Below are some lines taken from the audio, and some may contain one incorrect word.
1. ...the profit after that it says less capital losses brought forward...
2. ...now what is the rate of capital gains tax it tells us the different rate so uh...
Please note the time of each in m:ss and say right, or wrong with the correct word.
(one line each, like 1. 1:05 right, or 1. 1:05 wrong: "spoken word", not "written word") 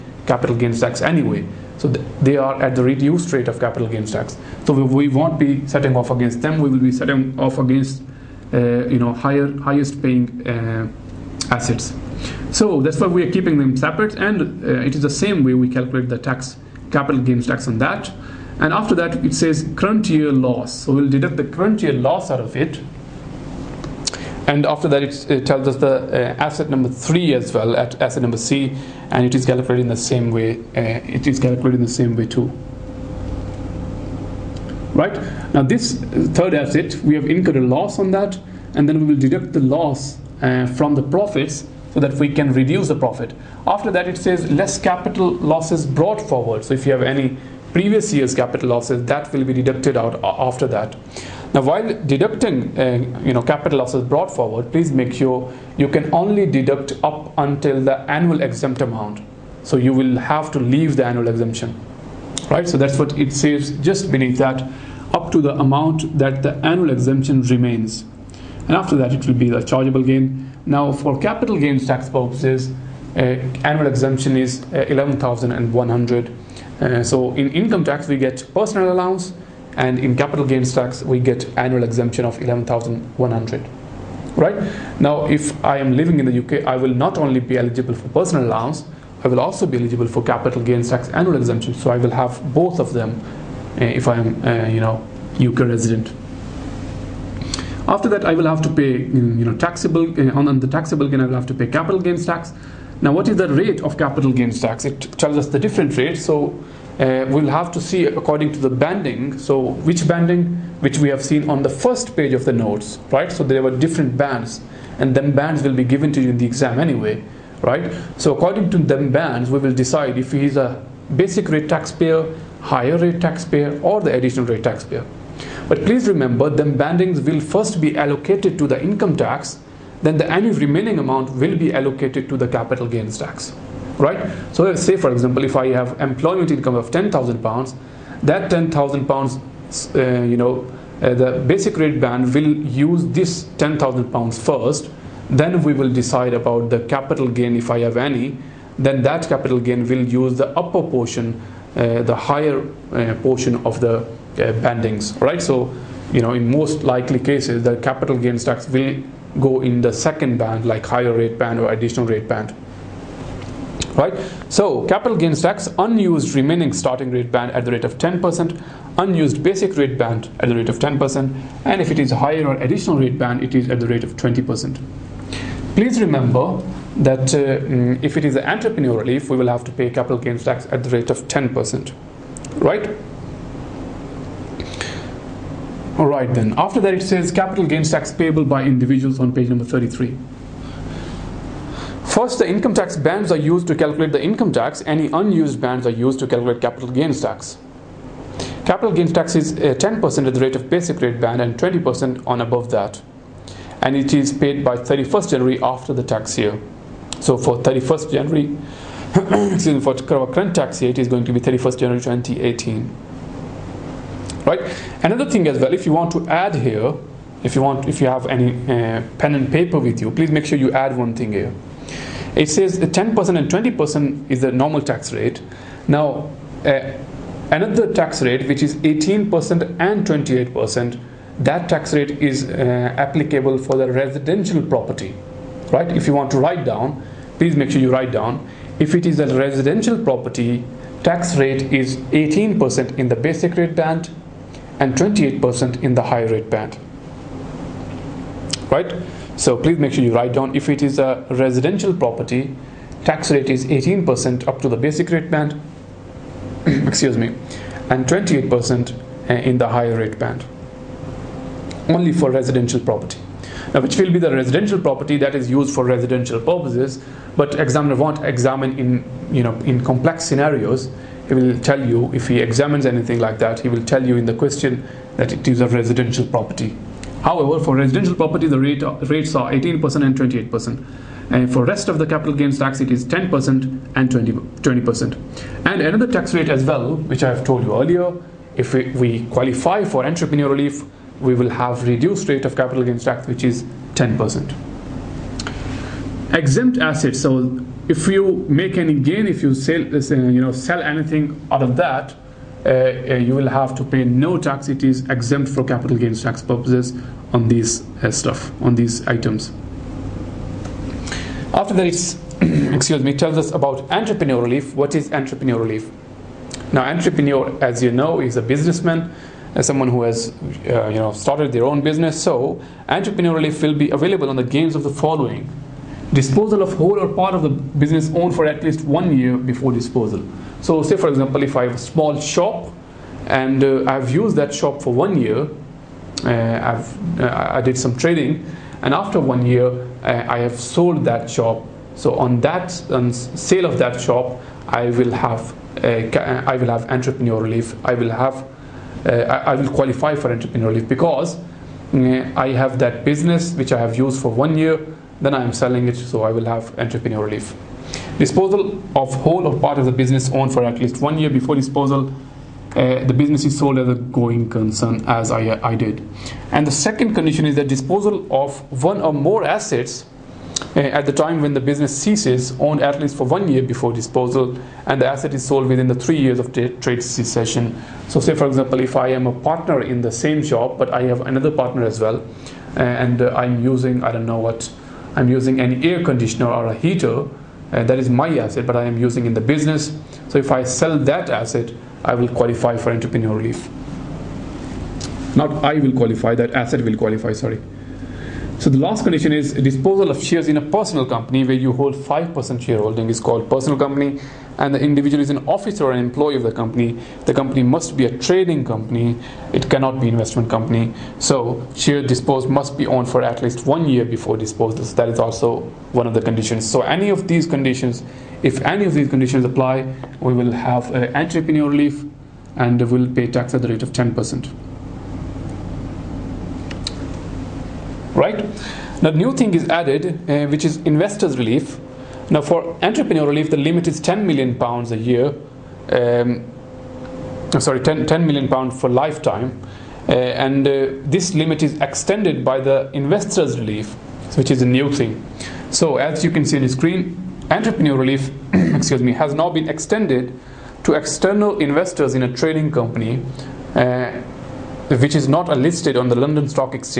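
1. 0:42 right
2. 1:43 right.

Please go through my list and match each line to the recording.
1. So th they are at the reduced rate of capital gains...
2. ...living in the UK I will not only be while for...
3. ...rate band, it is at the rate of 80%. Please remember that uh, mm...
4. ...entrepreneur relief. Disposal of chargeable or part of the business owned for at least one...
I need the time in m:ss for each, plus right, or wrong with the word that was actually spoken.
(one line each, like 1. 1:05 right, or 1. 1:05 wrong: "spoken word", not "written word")
1. 0:01 right
2. 1:25 wrong: "eligible", not "while"
3. 2:52 wrong: "20", not "80"
4. 5:56 wrong: "whole", not "chargeable".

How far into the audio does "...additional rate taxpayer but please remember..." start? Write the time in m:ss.
2:04.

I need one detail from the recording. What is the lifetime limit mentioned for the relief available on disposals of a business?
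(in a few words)
10 million pounds.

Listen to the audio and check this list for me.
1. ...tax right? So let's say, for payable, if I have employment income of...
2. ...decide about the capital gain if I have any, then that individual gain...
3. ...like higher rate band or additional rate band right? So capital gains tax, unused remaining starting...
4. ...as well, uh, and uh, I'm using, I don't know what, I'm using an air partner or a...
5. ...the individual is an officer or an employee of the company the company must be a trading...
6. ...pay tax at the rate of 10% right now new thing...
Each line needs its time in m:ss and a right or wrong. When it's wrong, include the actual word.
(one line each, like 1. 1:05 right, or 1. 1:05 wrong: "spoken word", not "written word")
1. 2:13 wrong: "example", not "payable"
2. 2:25 wrong: "capital", not "individual"
3. 2:40 right
4. 6:21 wrong: "conditioner", not "partner"
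5. 6:44 right
6. 7:03 right.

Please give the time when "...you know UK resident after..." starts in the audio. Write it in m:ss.
1:34.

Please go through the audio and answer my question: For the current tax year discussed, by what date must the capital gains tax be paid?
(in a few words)
31st January 2018.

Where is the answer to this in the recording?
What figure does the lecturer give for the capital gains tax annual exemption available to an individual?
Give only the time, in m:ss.
1:13.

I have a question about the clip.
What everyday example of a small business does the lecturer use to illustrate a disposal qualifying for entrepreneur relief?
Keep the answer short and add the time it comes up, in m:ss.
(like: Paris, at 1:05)
a small shop, at 5:31.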